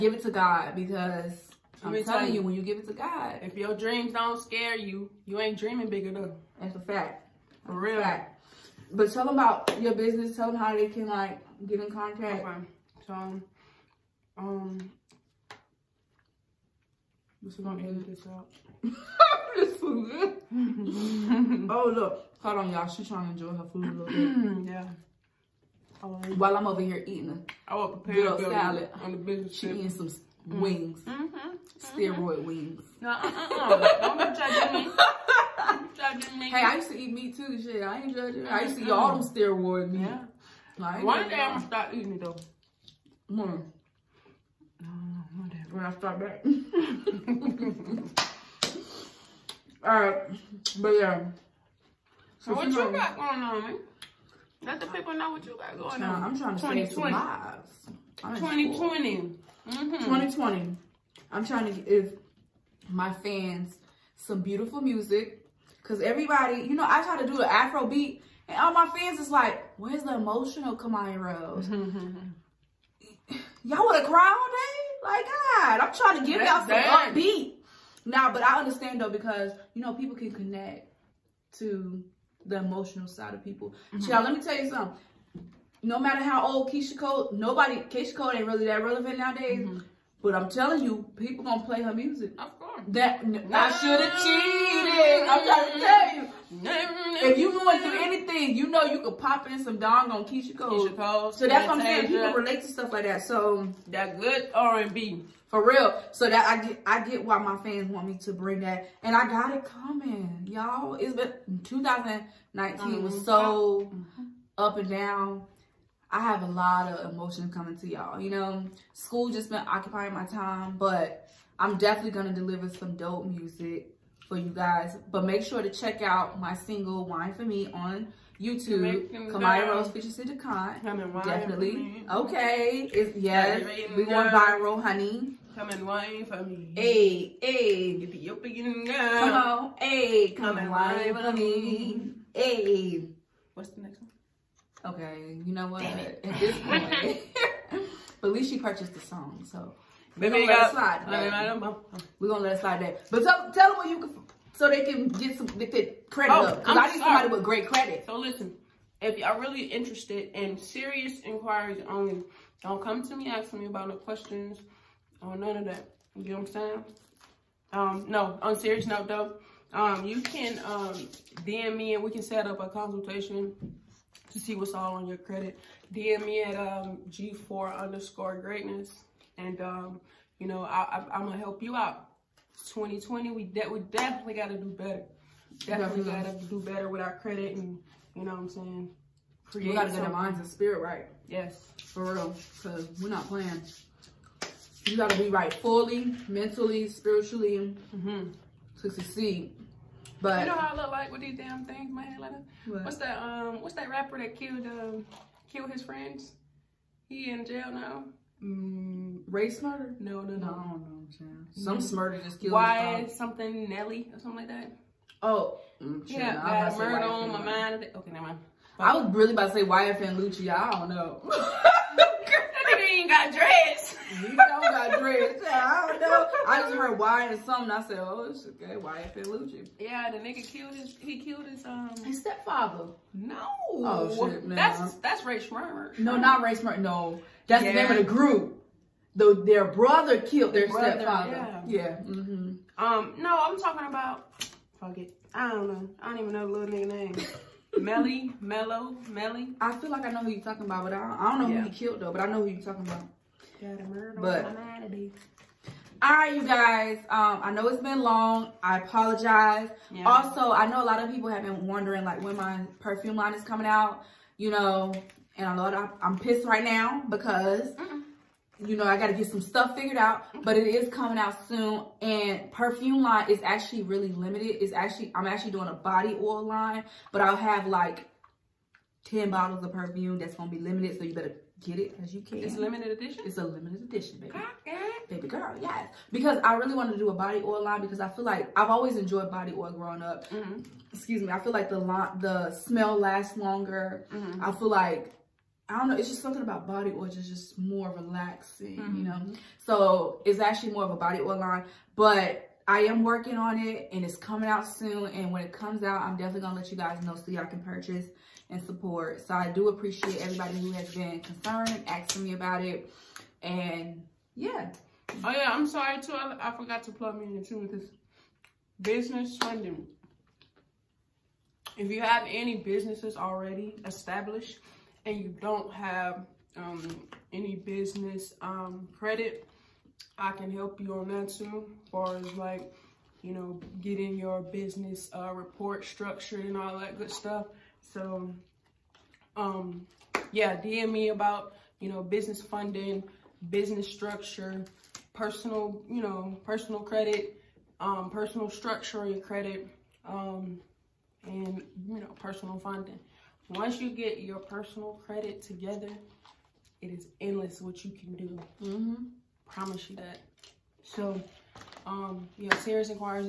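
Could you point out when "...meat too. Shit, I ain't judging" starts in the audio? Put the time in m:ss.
0:37.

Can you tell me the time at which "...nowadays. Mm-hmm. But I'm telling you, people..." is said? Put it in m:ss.
1:29.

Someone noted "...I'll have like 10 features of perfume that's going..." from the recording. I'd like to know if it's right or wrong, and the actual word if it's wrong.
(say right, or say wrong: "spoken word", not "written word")
wrong: "bottles", not "features".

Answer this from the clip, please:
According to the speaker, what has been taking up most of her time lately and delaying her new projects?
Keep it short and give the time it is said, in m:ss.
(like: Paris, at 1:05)
school, at 1:58.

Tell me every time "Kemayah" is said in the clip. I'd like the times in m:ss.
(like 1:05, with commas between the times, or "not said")
1:10, 2:09.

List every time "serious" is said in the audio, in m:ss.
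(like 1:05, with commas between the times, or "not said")
2:40, 2:48, 6:02.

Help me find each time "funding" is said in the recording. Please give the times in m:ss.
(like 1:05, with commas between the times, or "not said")
5:19, 5:42, 5:52.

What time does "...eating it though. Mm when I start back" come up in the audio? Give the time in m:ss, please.
0:41.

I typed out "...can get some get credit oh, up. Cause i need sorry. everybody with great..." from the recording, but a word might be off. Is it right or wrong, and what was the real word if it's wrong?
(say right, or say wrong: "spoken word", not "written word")
wrong: "somebody", not "everybody".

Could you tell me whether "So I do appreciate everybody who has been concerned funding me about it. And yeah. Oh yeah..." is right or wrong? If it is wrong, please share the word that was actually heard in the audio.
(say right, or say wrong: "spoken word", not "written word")
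wrong: "asking", not "funding".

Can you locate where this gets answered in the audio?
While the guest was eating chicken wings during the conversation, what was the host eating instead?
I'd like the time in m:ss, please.
0:28.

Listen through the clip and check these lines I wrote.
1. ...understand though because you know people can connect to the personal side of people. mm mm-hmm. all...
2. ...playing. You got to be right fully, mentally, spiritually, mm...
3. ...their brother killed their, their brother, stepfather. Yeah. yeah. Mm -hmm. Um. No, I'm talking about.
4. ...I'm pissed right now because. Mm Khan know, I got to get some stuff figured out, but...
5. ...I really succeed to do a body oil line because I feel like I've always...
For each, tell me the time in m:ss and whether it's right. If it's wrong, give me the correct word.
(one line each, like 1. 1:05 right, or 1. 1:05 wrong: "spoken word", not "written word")
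1. 1:18 wrong: "emotional", not "personal"
2. 3:13 right
3. 3:59 right
4. 4:26 wrong: "You", not "Khan"
5. 4:46 wrong: "wanted", not "succeed".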